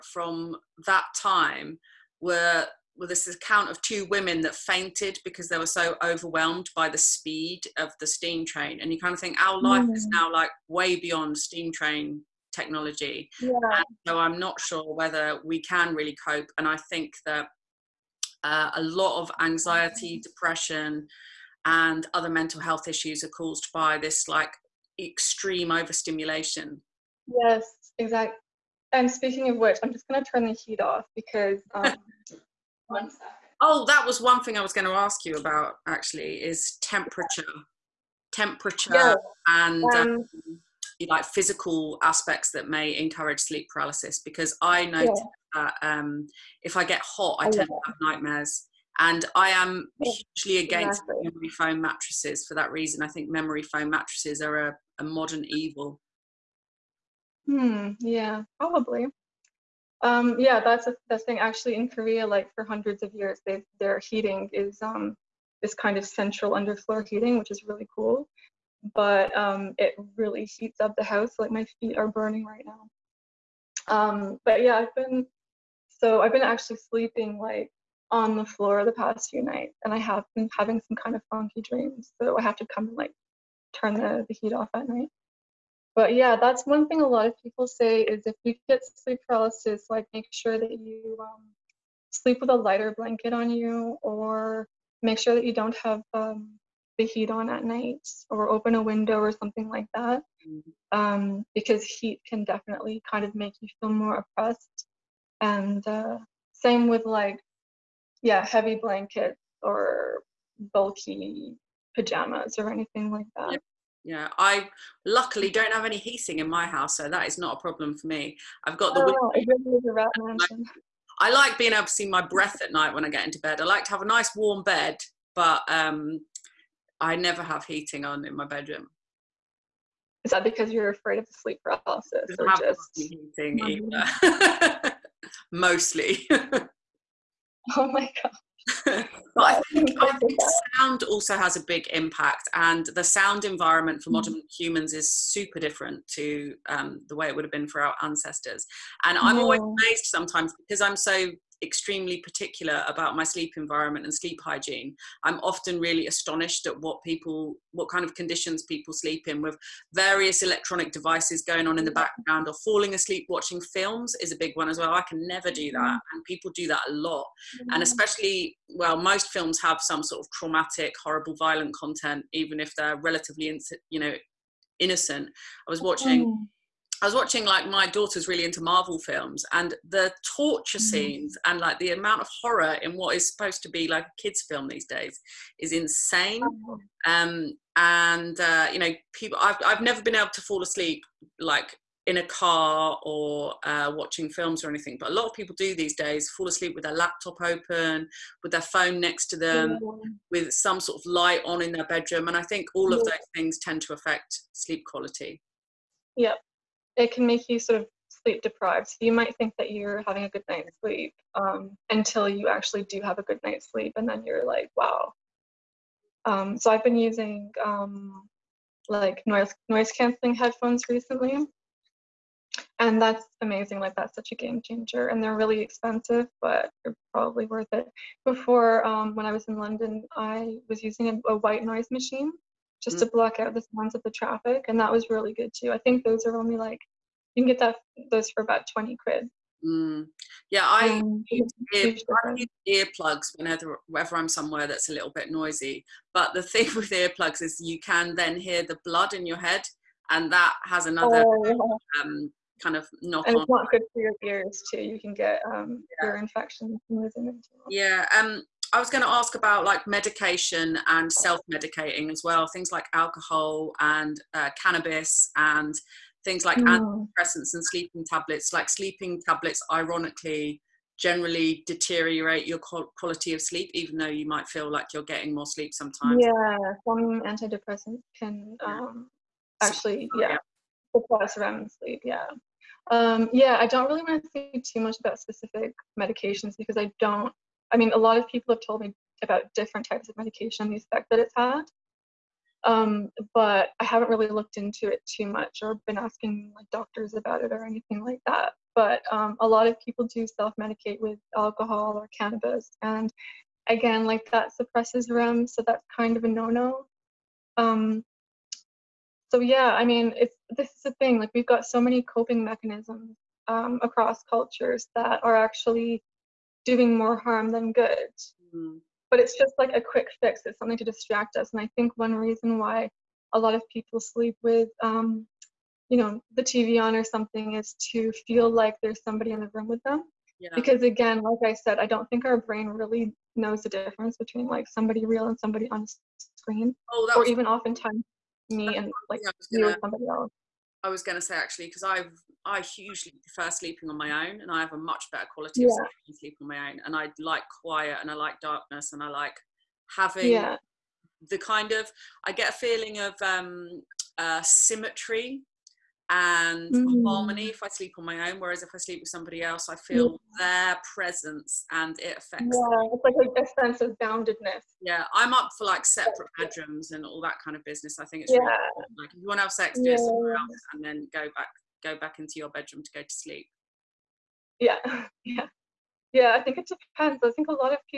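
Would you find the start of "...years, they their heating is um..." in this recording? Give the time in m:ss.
1:03.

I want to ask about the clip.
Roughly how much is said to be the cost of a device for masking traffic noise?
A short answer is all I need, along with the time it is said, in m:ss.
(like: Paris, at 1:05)
20 quid, at 3:58.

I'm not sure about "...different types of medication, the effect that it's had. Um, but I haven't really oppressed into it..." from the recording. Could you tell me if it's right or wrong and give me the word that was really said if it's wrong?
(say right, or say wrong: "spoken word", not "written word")
wrong: "looked", not "oppressed".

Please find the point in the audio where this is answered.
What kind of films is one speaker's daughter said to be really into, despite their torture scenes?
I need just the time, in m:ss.
2:58.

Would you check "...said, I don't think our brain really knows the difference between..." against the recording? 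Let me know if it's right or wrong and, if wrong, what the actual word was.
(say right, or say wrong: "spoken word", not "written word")
right.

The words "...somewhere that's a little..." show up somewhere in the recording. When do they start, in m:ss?
4:04.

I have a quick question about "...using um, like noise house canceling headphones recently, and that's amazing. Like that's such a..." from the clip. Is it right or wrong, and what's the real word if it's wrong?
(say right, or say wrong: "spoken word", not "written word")
wrong: "noise", not "house".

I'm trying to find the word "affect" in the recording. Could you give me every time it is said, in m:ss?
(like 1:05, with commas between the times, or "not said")
3:23, 6:02.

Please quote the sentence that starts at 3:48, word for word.
Before, um, when I was in London, I was using a, a white noise machine just mm-hmm.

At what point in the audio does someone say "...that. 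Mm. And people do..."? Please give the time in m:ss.
2:45.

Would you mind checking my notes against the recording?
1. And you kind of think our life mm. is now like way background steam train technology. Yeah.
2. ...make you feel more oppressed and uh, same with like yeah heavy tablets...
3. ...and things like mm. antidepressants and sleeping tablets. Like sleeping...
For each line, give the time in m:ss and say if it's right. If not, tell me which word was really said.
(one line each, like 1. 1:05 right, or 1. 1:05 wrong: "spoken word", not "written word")
1. 0:08 wrong: "beyond", not "background"
2. 1:43 wrong: "blankets", not "tablets"
3. 4:25 right.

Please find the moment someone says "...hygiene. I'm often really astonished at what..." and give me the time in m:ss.
2:34.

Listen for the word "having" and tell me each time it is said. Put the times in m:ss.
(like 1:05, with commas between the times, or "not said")
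1:20, 3:30, 5:49.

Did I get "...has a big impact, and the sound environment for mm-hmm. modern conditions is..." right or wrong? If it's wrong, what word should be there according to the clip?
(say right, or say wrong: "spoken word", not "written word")
wrong: "humans", not "conditions".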